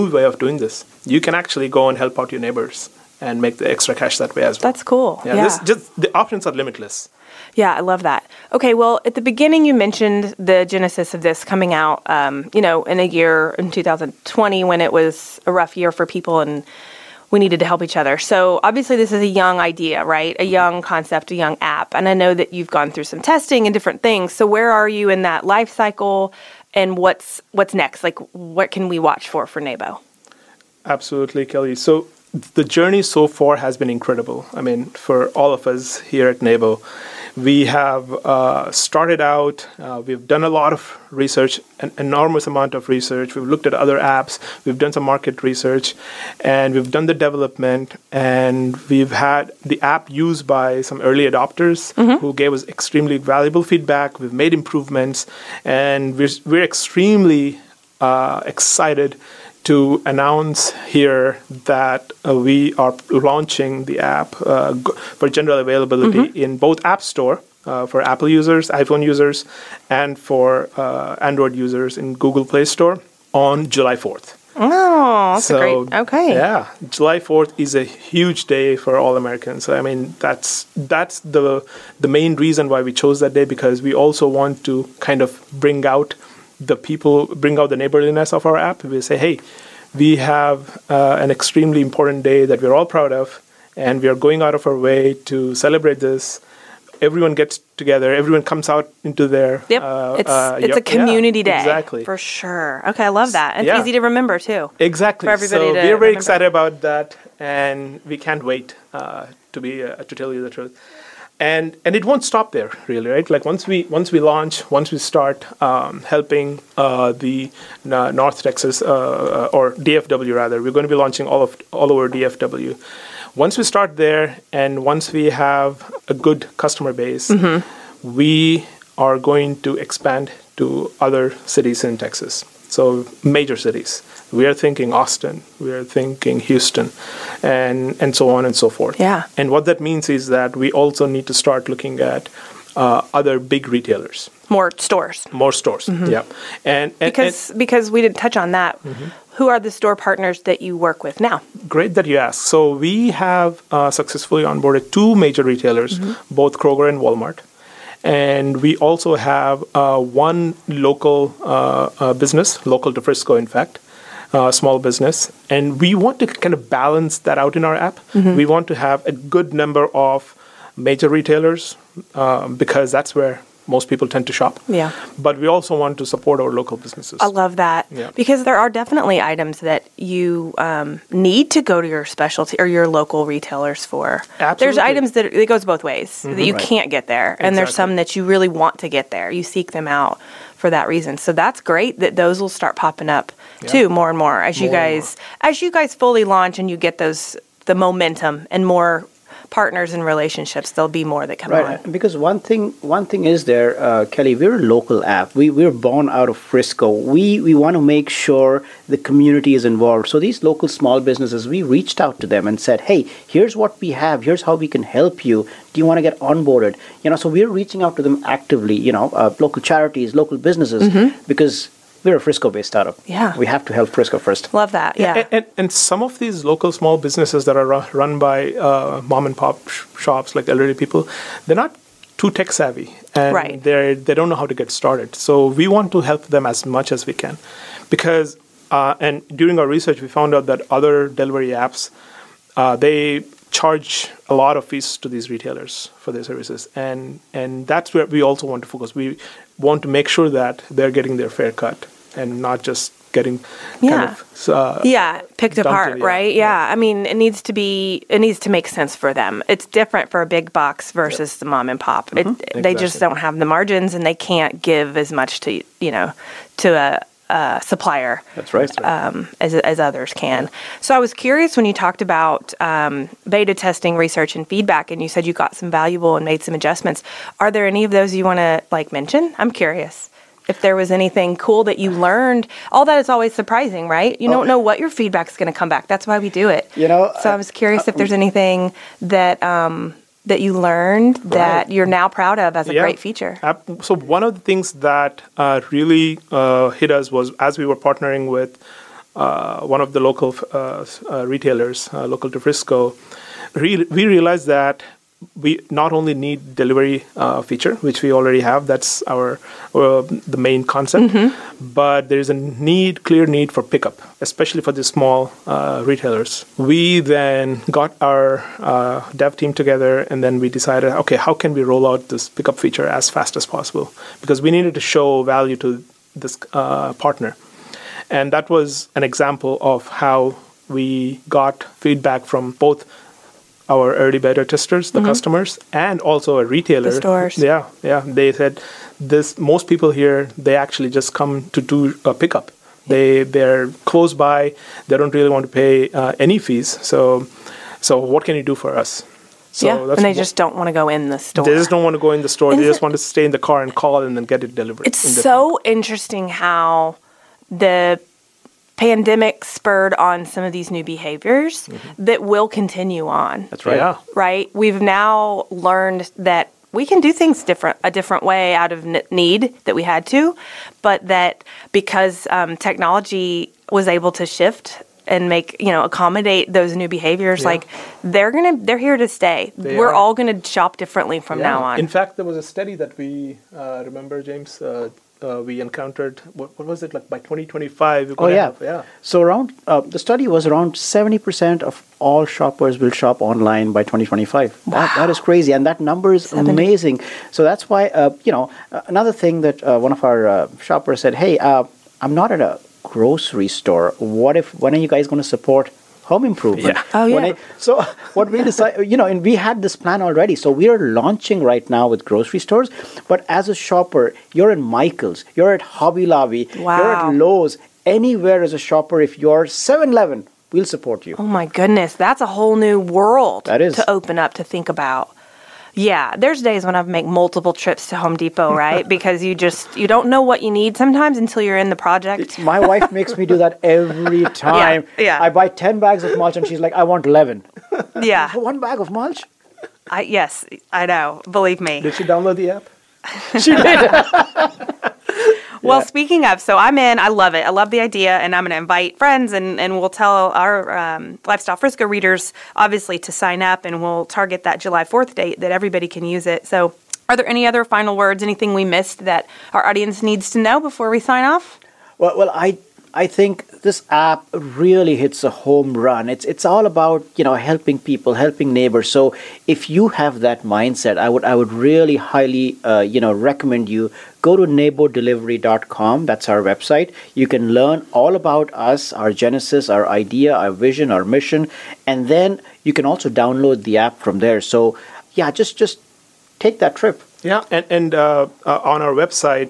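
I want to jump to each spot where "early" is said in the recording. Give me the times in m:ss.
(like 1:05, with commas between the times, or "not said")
0:51, 5:33.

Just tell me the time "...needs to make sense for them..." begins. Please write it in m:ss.
4:18.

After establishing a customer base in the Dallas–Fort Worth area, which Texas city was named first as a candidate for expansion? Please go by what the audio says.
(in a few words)
Austin.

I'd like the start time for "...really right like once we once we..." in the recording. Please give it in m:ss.
1:52.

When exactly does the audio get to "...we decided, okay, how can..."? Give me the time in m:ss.
5:20.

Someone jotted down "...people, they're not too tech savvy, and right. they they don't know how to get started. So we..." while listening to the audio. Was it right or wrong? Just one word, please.
right.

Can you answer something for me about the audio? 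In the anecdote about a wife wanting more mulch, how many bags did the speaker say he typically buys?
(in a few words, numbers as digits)
10.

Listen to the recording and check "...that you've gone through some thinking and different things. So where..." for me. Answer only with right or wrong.
wrong.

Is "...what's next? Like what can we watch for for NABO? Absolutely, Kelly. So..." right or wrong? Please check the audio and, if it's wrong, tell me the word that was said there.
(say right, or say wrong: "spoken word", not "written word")
right.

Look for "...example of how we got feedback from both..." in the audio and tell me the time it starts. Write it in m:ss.
5:29.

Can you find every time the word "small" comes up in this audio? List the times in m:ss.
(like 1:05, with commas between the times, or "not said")
2:44, 3:30, 3:46, 5:14.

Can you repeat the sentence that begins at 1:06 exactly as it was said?
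in both App Store uh, for Apple users, iPhone users, and for uh, Android users in Google Play Store on July 4th.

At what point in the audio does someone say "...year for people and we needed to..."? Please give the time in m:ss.
0:15.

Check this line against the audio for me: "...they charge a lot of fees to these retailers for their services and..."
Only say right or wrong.
right.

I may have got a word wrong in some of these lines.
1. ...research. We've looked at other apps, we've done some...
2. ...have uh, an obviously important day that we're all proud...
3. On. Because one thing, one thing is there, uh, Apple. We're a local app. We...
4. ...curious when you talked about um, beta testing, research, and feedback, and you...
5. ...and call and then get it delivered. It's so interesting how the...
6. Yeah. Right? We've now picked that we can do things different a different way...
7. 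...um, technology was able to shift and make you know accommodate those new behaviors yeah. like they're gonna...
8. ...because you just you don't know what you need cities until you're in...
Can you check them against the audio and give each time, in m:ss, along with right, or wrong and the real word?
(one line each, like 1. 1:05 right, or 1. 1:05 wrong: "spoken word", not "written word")
1. 0:42 right
2. 1:30 wrong: "extremely", not "obviously"
3. 3:21 wrong: "Kelly", not "Apple"
4. 4:31 right
5. 5:53 right
6. 6:03 wrong: "learned", not "picked"
7. 6:12 right
8. 7:08 wrong: "sometimes", not "cities".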